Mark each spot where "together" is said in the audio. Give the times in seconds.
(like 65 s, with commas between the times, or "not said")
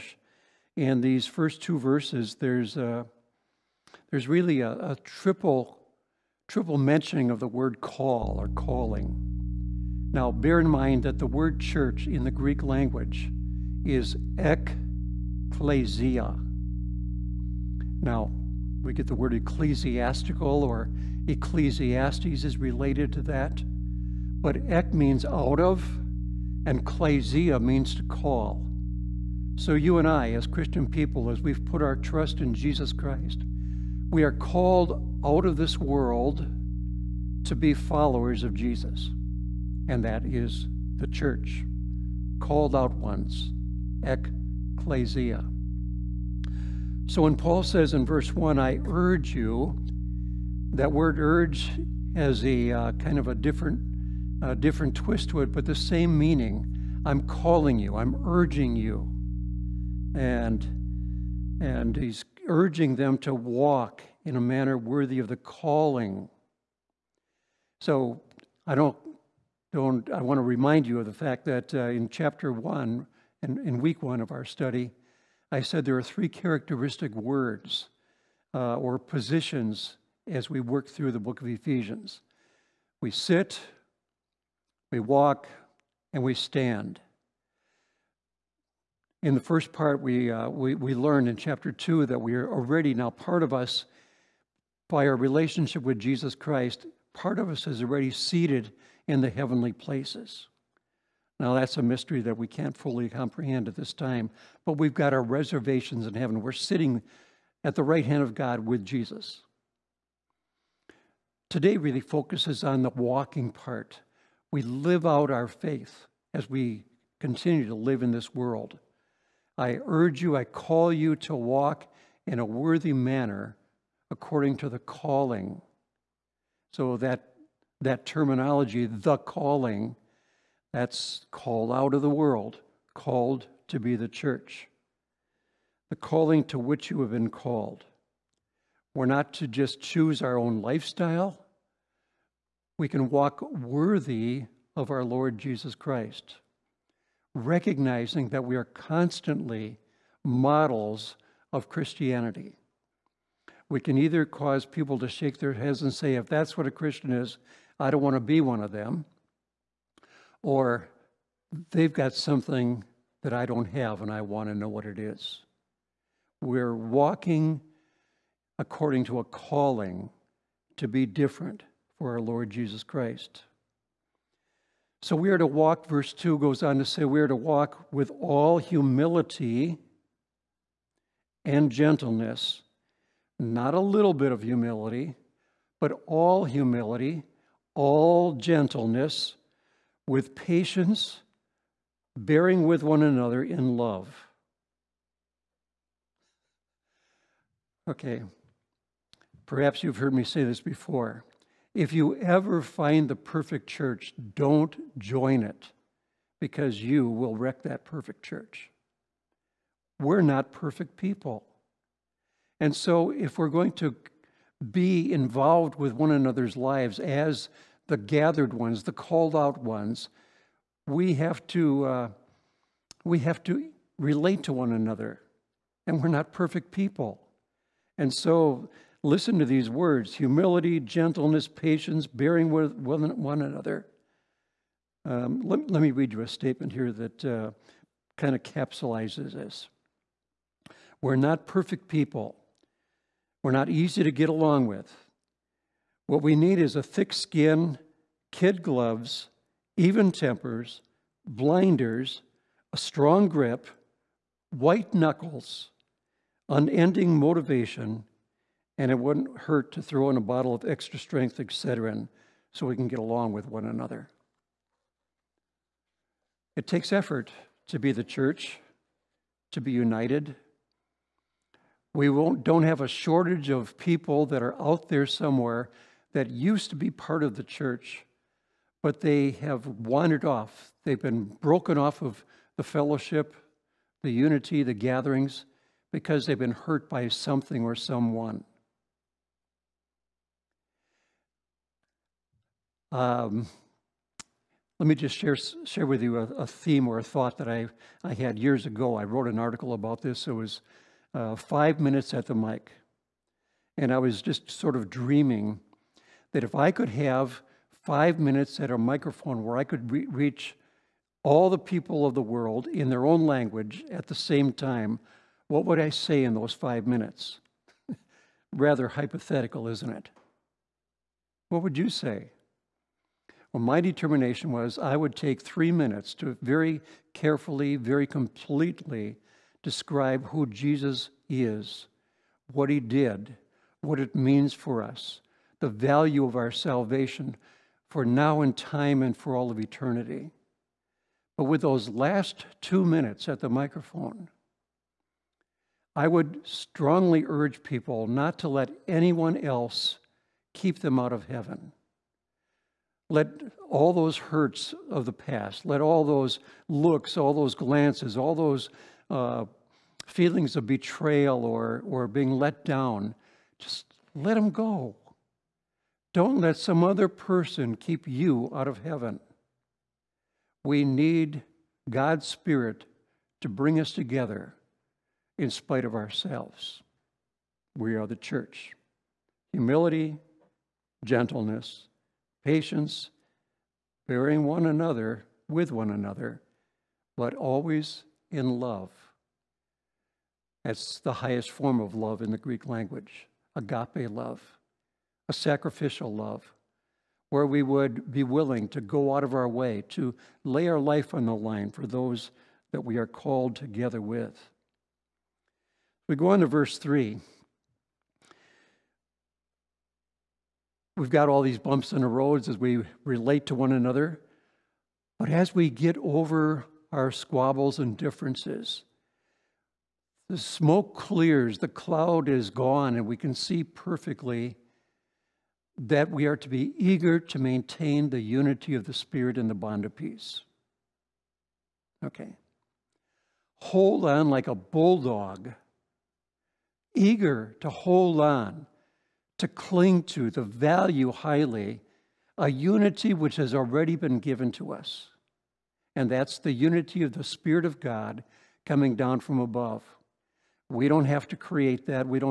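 373 s, 403 s.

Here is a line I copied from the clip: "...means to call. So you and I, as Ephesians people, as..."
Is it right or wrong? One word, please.
wrong.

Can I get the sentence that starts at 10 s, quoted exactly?
Now, bear in mind that the word church in the Greek language is ekklesia.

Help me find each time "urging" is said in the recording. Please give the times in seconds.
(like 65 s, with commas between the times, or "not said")
58 s, 62 s.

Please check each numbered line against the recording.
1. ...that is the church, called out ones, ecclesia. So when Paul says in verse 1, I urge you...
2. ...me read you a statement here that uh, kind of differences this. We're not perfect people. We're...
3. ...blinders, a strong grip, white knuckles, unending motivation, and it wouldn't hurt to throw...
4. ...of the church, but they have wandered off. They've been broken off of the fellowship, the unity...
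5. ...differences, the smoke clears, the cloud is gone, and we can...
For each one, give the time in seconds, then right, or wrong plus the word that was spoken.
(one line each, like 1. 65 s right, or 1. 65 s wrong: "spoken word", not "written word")
1. 40 s right
2. 235 s wrong: "capsulizes", not "differences"
3. 251 s right
4. 277 s right
5. 417 s right.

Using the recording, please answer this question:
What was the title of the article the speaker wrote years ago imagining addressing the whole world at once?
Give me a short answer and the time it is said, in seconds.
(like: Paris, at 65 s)
Five minutes at the mic, at 301 s.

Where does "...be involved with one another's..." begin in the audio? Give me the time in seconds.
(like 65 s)
214 s.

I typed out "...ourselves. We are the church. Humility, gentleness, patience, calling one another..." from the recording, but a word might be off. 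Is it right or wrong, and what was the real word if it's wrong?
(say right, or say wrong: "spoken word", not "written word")
wrong: "bearing", not "calling".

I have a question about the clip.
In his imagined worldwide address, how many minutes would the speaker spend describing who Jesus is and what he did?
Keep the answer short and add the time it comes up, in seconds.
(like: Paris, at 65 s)
3, at 325 s.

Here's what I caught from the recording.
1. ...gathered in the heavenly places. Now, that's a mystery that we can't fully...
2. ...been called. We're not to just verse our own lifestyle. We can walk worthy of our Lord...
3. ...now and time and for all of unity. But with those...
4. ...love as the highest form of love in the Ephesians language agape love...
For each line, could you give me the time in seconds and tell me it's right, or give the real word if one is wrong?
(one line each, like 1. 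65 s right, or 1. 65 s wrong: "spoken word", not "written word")
1. 98 s wrong: "seated", not "gathered"
2. 137 s wrong: "choose", not "verse"
3. 338 s wrong: "eternity", not "unity"
4. 388 s wrong: "Greek", not "Ephesians".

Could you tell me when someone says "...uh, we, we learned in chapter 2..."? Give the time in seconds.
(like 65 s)
90 s.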